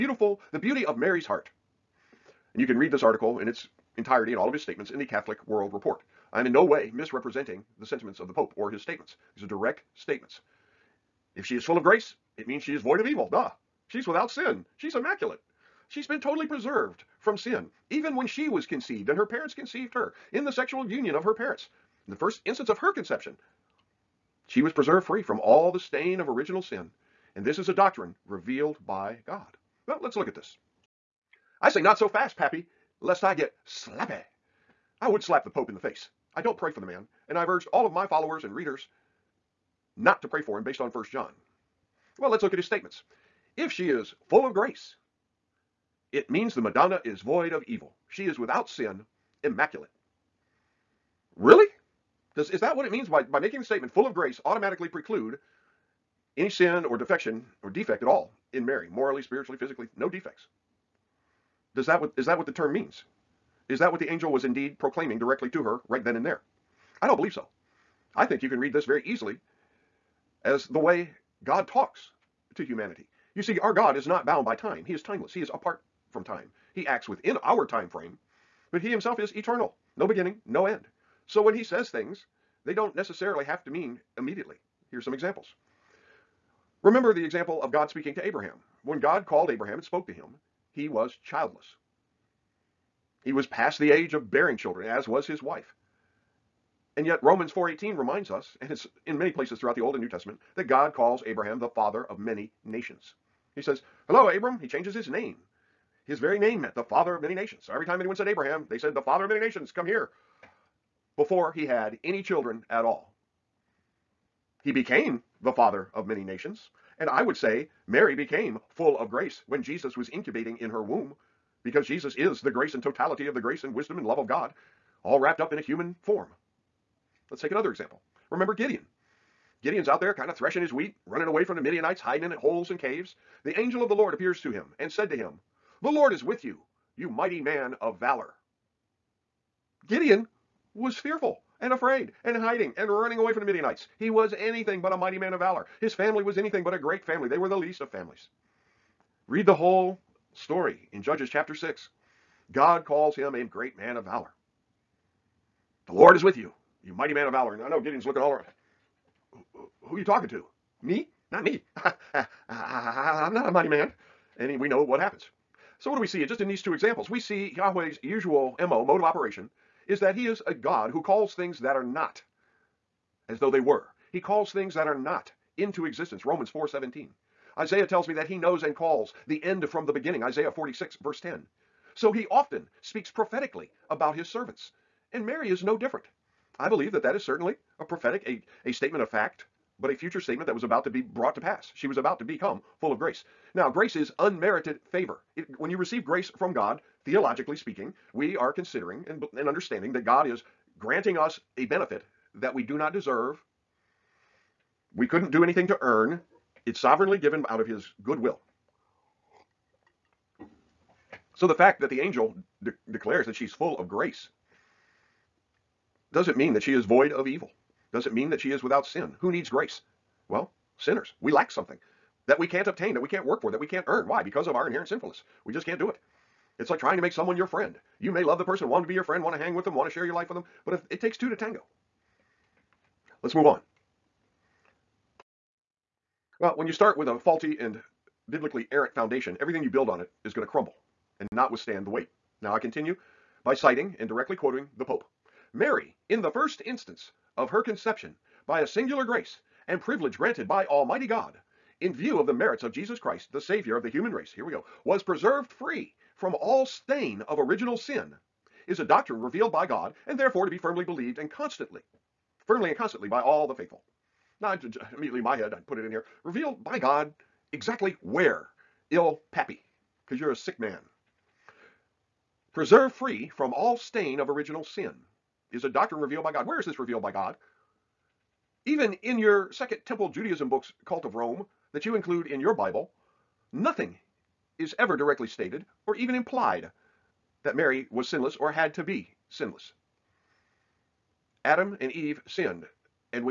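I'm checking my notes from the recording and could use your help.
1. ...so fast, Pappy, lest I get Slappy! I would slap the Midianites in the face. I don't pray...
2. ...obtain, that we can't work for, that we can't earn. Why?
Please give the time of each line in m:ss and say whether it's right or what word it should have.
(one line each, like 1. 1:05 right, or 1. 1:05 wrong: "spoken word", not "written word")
1. 0:31 wrong: "Pope", not "Midianites"
2. 3:42 right.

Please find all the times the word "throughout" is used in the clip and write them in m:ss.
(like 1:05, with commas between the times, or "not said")
1:39.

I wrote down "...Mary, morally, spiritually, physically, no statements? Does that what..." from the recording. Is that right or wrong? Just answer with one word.
wrong.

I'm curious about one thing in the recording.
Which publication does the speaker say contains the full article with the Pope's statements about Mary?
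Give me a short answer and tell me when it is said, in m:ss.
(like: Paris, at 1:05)
Catholic World Report, at 0:05.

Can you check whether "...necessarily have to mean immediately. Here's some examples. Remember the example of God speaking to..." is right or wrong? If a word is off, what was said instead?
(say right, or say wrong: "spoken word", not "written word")
right.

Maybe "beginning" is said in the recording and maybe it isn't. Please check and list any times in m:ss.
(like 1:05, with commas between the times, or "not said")
1:20, 2:59.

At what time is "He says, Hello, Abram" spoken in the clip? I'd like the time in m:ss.
1:43.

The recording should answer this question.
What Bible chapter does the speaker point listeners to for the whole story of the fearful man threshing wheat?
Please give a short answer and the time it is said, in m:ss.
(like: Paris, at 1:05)
Judges chapter 6, at 2:31.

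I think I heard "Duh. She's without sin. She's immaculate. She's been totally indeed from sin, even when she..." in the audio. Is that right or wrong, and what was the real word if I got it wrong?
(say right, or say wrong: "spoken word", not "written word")
wrong: "preserved", not "indeed".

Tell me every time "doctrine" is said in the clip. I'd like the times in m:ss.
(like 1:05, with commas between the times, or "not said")
0:27, 4:18, 4:35.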